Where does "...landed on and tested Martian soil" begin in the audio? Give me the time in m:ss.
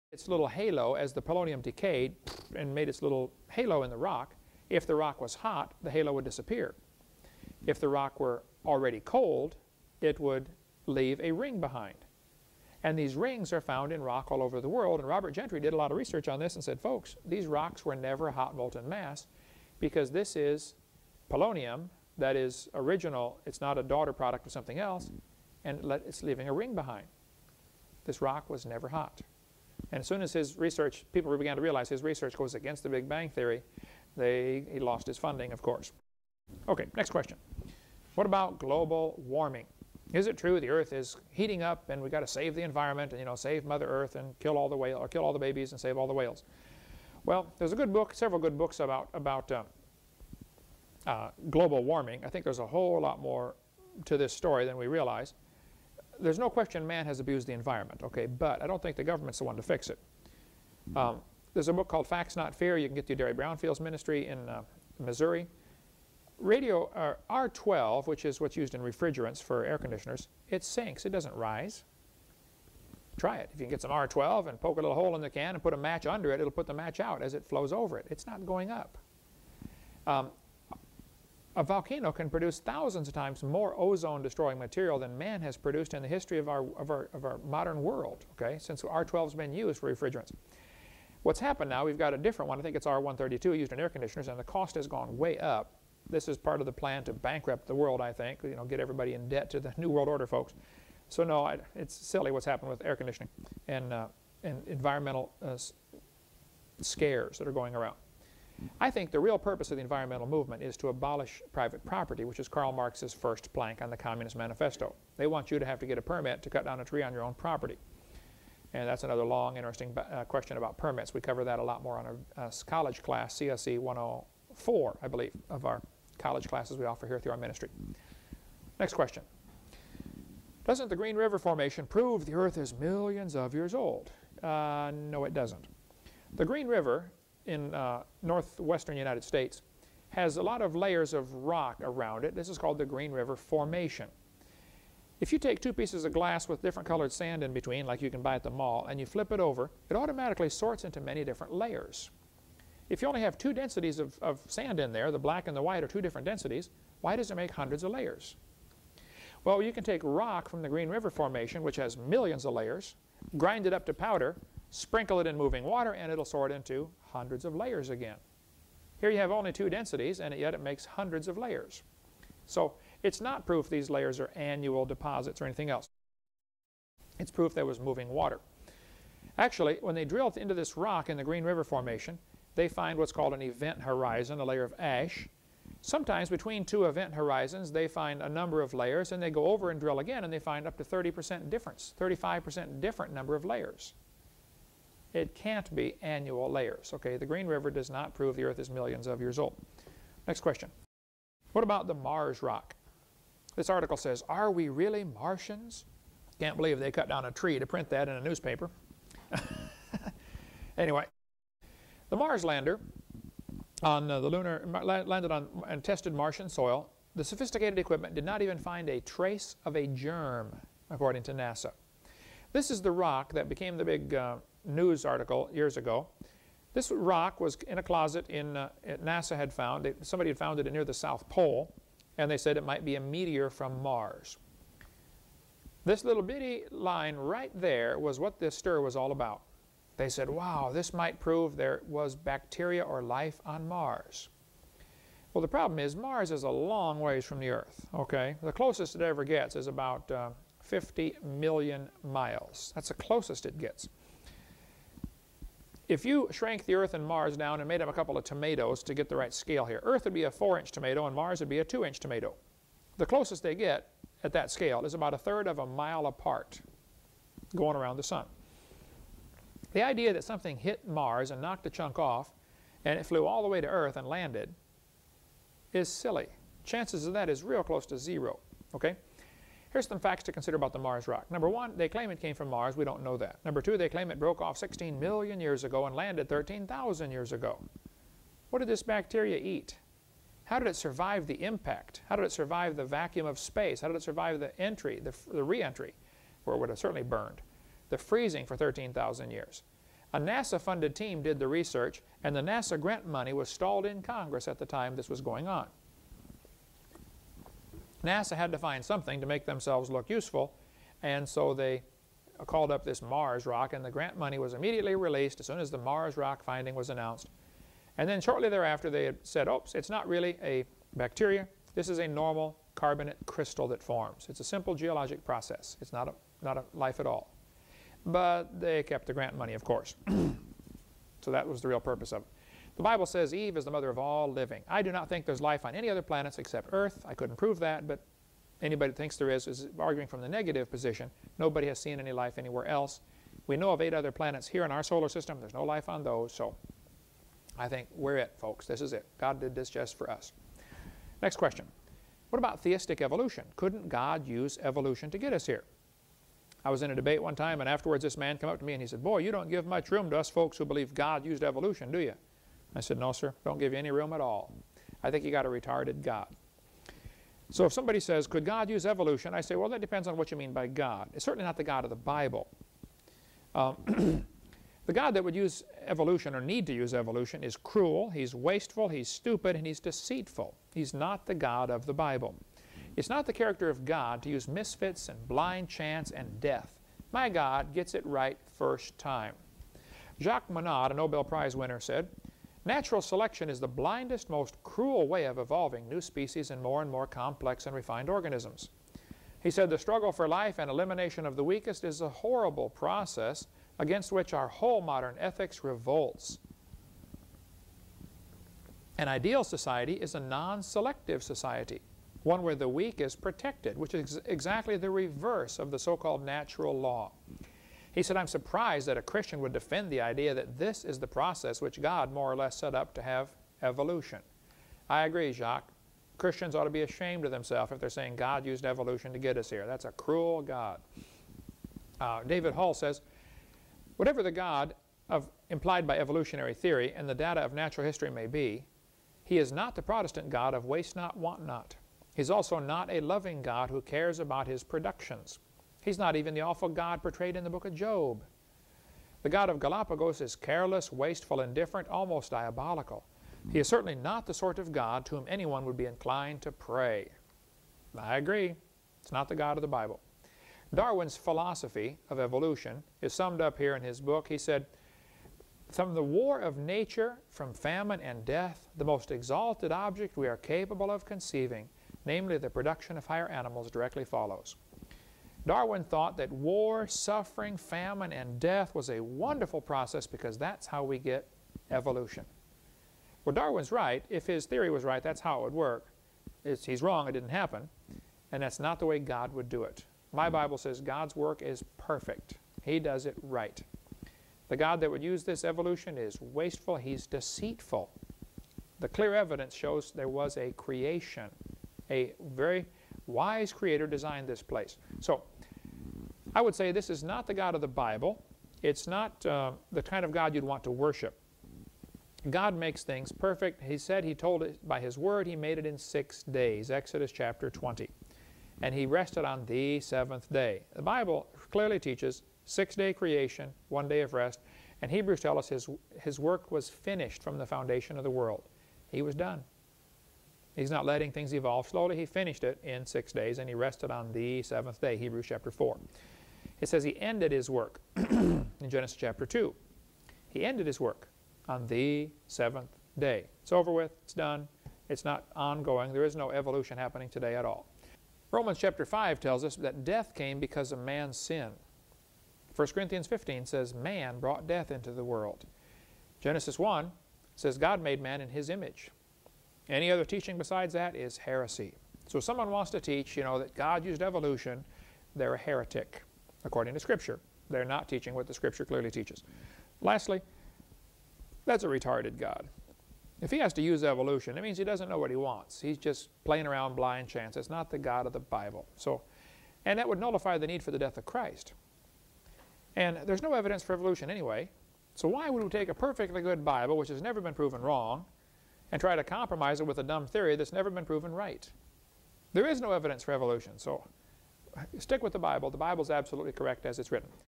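3:35.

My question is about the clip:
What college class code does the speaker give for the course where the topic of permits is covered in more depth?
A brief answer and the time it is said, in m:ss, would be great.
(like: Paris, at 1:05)
CSE 104, at 2:03.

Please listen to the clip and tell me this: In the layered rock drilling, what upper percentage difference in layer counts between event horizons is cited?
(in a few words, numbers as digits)
35%.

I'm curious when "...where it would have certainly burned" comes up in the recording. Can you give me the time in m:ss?
4:56.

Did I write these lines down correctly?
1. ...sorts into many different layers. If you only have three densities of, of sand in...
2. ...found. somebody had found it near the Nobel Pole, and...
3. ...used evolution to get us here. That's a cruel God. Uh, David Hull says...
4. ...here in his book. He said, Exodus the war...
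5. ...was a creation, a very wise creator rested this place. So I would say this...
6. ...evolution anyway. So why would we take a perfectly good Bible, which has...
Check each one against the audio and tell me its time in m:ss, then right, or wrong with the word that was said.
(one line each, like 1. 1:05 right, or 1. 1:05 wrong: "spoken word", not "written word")
1. 2:30 wrong: "two", not "three"
2. 3:49 wrong: "South", not "Nobel"
3. 7:08 right
4. 7:43 wrong: "From", not "Exodus"
5. 8:20 wrong: "designed", not "rested"
6. 9:43 right.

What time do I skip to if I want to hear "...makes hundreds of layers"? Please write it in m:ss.
2:50.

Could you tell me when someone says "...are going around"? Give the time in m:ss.
1:47.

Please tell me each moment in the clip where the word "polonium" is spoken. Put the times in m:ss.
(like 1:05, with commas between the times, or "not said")
0:01, 0:21.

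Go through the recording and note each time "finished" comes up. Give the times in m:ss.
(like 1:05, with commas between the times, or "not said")
8:46, 8:52.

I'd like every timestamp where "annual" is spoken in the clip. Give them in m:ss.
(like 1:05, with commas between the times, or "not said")
2:54, 3:16.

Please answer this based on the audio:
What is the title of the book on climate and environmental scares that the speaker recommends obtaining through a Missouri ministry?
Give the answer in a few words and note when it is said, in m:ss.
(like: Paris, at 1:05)
Facts Not Fear, at 1:02.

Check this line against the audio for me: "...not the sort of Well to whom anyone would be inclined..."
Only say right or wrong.
wrong.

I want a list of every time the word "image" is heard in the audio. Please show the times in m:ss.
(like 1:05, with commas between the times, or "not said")
9:18.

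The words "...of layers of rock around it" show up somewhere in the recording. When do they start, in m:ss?
2:20.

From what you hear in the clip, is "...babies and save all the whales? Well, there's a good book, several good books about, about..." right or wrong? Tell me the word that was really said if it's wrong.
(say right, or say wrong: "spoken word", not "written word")
right.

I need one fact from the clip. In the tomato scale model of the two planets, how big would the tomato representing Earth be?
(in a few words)
4 inches.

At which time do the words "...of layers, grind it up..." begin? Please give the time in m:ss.
2:42.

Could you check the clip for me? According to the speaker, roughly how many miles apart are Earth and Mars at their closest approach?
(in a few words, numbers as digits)
50 million miles.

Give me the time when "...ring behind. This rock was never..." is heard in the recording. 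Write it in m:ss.
0:26.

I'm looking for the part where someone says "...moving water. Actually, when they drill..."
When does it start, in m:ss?
2:57.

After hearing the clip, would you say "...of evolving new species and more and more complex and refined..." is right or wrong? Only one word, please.
right.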